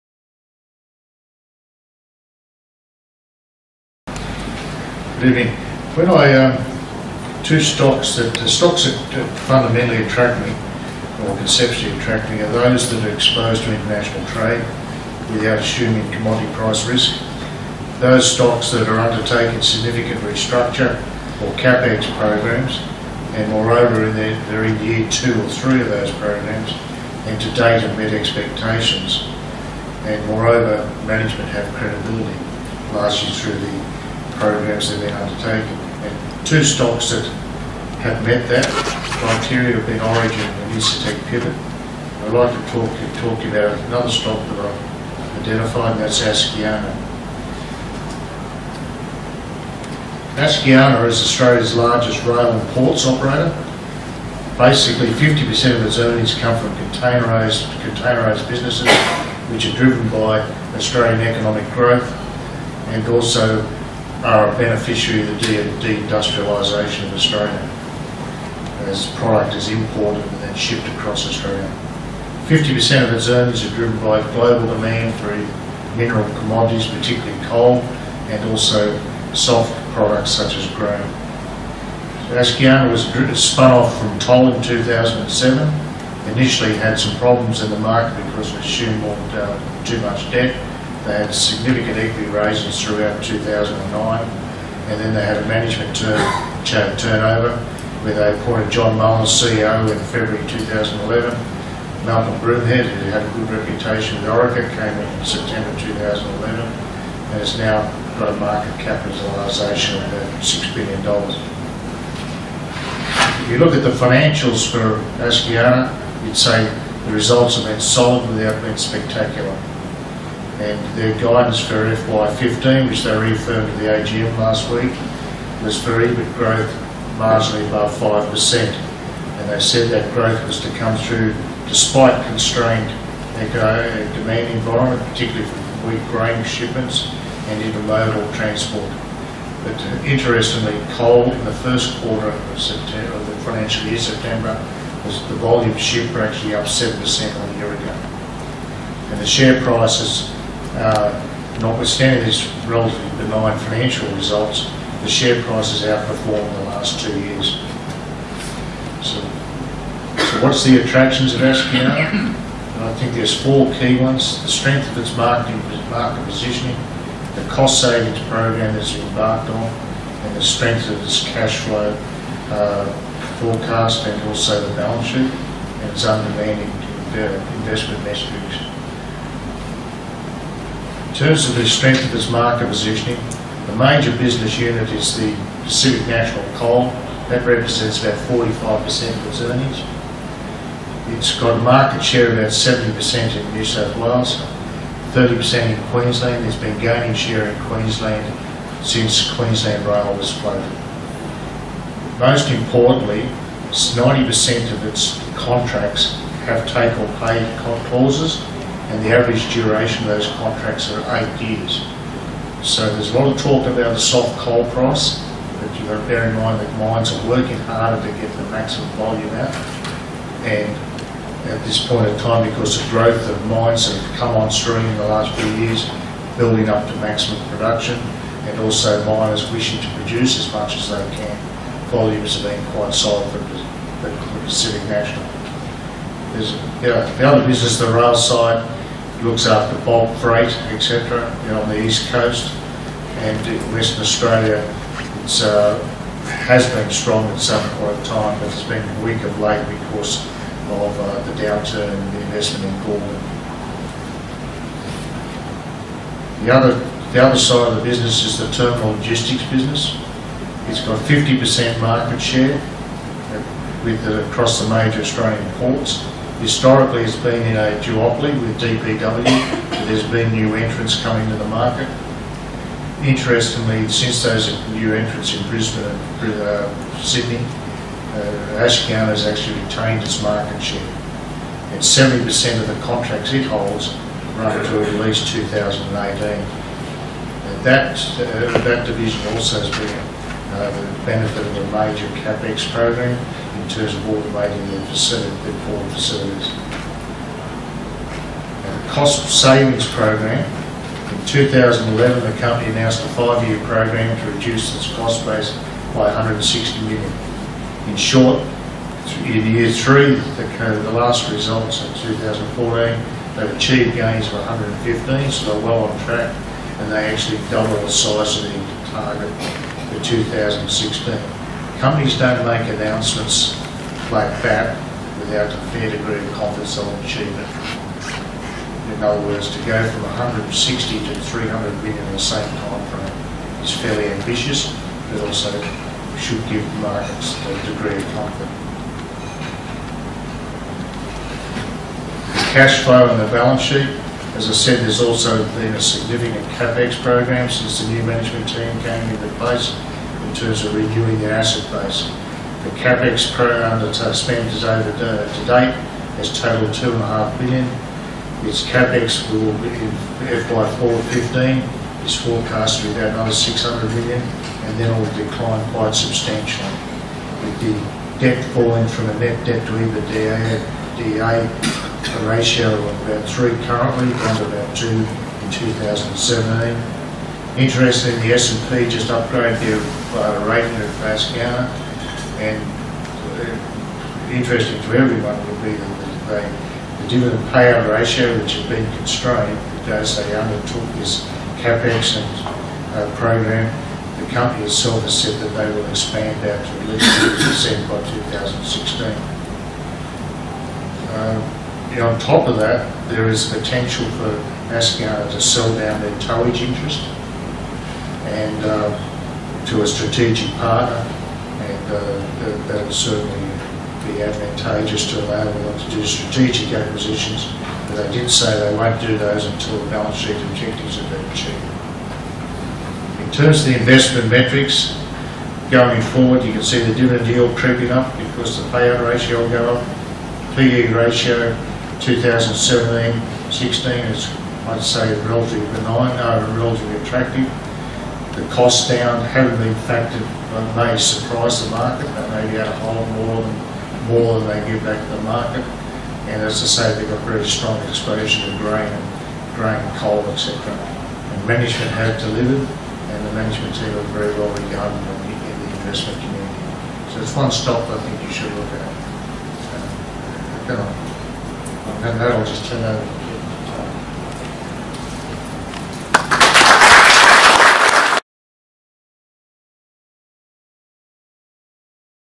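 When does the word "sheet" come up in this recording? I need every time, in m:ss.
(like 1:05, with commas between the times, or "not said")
2:55, 5:43, 7:00.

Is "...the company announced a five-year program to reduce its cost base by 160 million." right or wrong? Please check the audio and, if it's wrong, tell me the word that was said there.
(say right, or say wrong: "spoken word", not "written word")
right.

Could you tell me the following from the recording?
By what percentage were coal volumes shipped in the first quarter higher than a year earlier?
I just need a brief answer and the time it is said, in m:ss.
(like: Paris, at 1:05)
7%, at 2:26.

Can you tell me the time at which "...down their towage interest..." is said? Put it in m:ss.
6:45.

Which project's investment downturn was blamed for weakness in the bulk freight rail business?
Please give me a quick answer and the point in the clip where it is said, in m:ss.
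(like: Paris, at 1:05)
Gorgon, at 4:12.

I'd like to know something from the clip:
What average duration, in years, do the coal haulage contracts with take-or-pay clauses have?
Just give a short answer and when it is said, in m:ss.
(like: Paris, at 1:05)
8 years, at 3:31.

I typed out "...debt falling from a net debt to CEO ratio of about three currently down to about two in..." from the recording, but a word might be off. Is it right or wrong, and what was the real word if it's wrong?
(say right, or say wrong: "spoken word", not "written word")
wrong: "EBITDA", not "CEO".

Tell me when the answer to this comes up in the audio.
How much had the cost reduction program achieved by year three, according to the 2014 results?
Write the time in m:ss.
5:14.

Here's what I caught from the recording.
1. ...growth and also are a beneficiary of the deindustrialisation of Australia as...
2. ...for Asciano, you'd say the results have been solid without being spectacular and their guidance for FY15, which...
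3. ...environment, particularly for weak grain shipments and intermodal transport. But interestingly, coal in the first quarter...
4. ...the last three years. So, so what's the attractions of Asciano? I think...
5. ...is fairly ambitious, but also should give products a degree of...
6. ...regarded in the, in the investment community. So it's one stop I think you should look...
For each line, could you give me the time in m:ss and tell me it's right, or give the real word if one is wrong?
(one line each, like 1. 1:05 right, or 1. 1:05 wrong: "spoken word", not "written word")
1. 1:01 right
2. 1:54 right
3. 2:14 right
4. 2:36 wrong: "two", not "three"
5. 5:33 wrong: "markets", not "products"
6. 7:34 right.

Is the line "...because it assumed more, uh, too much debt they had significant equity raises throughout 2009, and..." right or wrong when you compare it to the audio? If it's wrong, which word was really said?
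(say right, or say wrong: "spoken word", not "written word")
right.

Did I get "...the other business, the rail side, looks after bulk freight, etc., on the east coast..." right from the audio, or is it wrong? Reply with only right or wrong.
right.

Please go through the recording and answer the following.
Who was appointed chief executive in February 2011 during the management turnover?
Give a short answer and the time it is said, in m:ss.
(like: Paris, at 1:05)
John Mullins, at 1:38.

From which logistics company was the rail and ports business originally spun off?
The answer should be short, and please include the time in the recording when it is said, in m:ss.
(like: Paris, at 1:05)
Toll, at 1:23.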